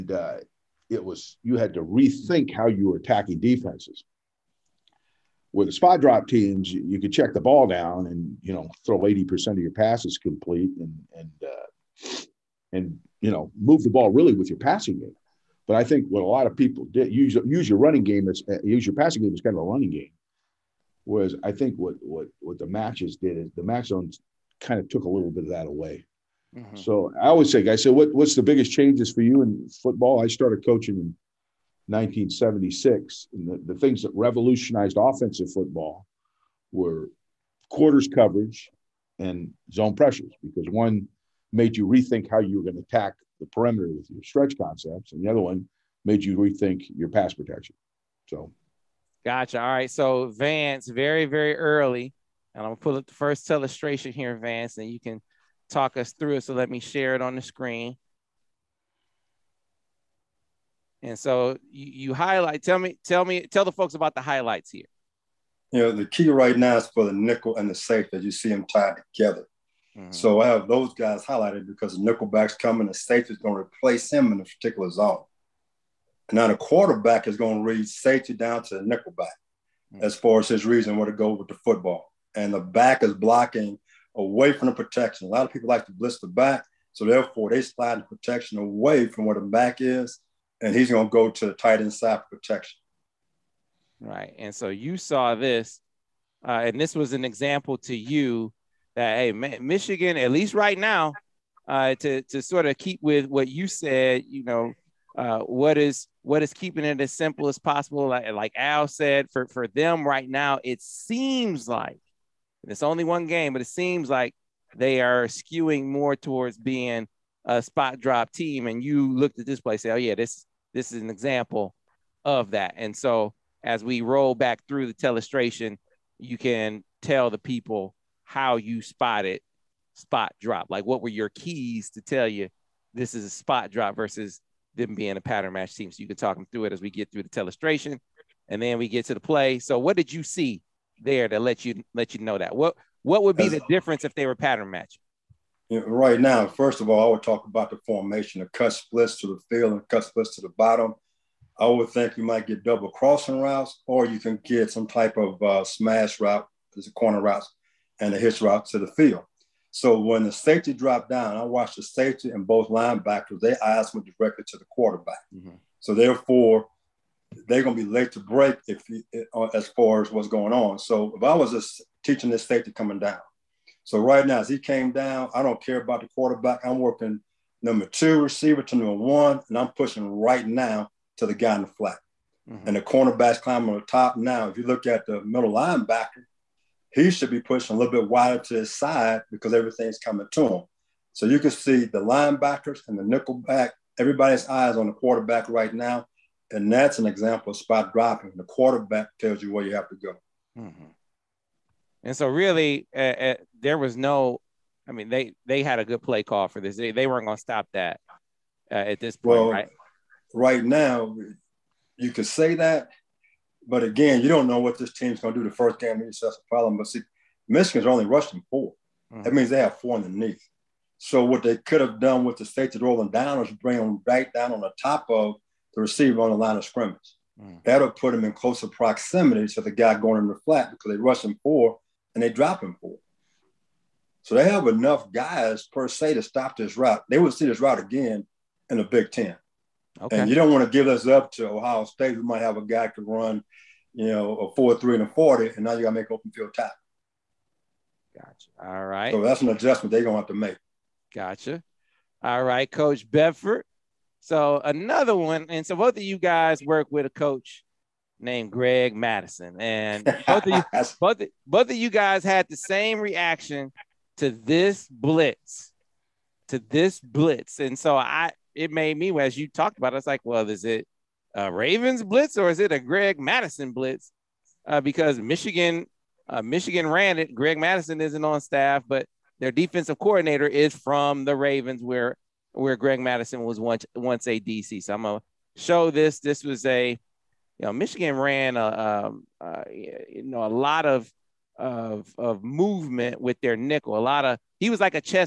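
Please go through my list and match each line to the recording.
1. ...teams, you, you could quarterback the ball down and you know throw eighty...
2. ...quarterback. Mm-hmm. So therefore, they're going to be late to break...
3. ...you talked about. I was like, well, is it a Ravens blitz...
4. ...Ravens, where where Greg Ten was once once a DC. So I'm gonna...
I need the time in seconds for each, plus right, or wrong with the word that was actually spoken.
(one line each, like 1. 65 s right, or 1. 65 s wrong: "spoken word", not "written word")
1. 6 s wrong: "check", not "quarterback"
2. 164 s right
3. 269 s right
4. 281 s wrong: "Mattison", not "Ten".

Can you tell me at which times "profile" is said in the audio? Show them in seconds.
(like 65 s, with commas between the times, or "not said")
not said.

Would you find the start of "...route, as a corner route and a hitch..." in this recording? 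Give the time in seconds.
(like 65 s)
156 s.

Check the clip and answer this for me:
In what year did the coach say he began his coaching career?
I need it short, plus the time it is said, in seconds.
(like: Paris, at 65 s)
1976, at 31 s.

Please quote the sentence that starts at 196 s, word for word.
And that's an example of spot dropping.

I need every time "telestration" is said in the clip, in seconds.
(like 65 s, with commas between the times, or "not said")
124 s, 137 s.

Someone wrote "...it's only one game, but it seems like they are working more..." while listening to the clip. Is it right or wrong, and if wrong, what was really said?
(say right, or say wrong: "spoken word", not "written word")
wrong: "skewing", not "working".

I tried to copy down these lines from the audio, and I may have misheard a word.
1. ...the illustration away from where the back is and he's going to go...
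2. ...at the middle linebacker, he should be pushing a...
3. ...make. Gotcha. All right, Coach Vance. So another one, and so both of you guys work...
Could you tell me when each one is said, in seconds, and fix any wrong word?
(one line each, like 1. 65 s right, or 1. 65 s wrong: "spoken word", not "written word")
1. 87 s wrong: "protection", not "illustration"
2. 184 s right
3. 250 s wrong: "Bedford", not "Vance".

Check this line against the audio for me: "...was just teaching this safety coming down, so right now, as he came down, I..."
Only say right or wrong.
right.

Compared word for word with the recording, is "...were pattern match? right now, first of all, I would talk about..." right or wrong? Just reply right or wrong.
right.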